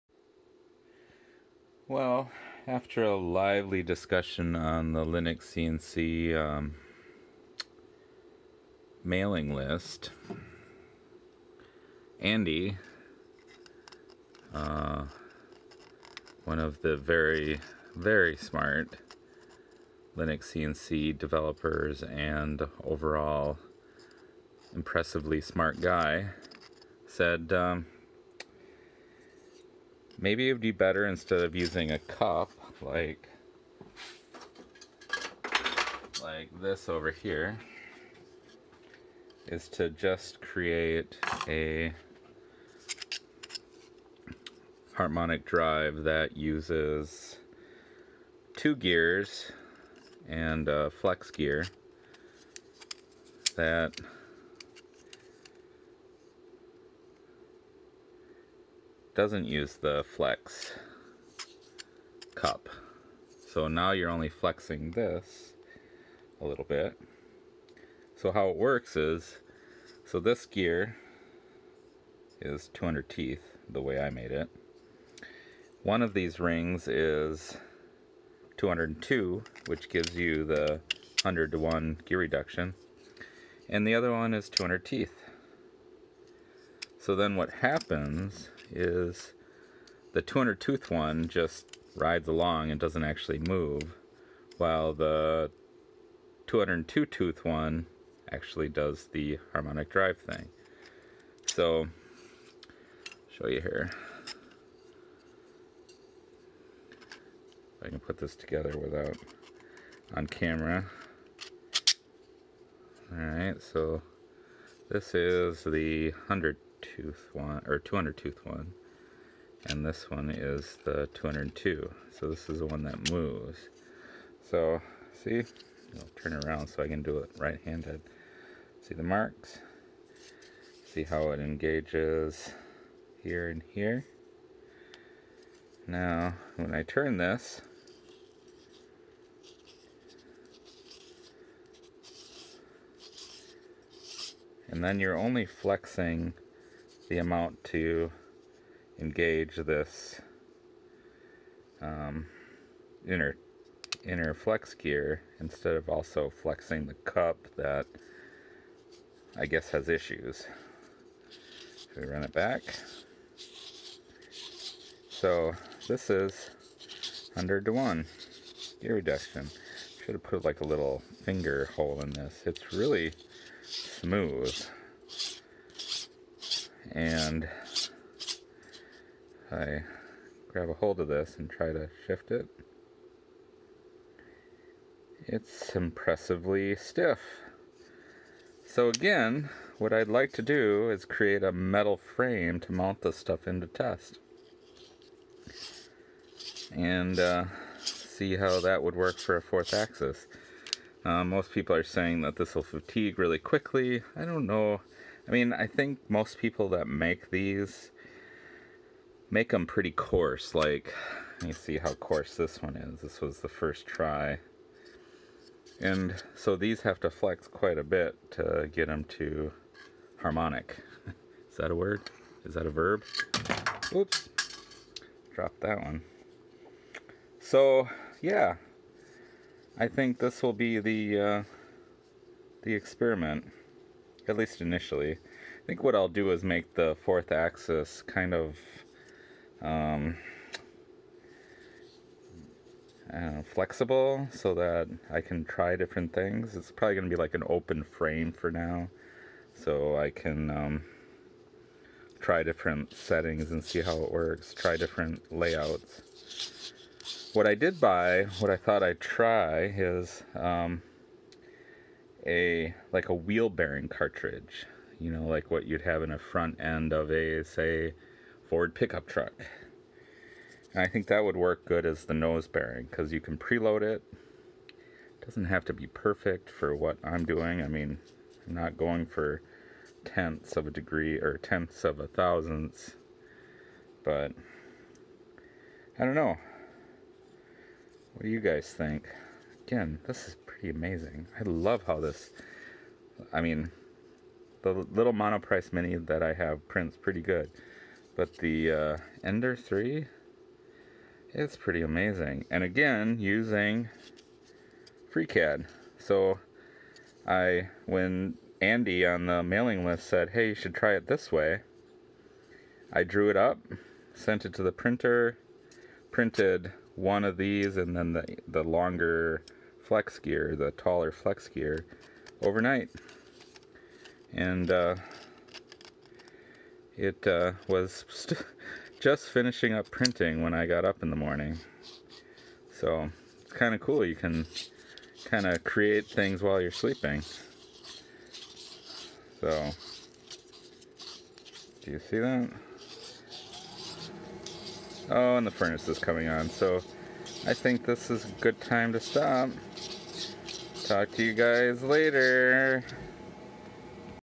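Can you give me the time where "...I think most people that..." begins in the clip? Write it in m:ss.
3:25.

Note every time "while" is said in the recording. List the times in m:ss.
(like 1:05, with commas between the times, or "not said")
1:34, 5:36.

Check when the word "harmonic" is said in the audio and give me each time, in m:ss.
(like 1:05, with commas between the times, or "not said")
0:44, 1:39, 3:40.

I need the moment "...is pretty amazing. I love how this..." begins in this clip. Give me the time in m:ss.
4:50.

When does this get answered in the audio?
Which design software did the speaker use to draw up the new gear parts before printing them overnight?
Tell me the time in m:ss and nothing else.
5:05.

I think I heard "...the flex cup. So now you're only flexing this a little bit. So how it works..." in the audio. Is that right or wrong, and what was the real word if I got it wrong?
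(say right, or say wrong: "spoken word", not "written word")
right.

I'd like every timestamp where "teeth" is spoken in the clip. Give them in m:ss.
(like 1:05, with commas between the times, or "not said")
1:13, 1:24.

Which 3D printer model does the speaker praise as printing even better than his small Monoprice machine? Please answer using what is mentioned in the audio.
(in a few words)
Ender 3.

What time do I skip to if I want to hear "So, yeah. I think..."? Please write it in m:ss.
3:47.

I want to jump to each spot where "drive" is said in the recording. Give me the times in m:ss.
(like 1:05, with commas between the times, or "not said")
0:45, 1:39.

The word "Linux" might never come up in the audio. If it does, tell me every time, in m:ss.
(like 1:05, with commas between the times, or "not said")
0:05, 0:20.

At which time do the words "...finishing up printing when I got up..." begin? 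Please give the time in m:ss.
5:29.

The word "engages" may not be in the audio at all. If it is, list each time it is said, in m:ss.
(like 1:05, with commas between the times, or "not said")
2:11, 2:28.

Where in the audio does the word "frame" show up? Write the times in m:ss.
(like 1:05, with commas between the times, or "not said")
3:12, 4:07.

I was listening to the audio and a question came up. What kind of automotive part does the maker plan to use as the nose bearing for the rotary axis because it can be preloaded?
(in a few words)
Wheel bearing cartridge.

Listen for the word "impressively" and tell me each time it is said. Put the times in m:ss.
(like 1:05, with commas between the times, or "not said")
0:24, 3:05.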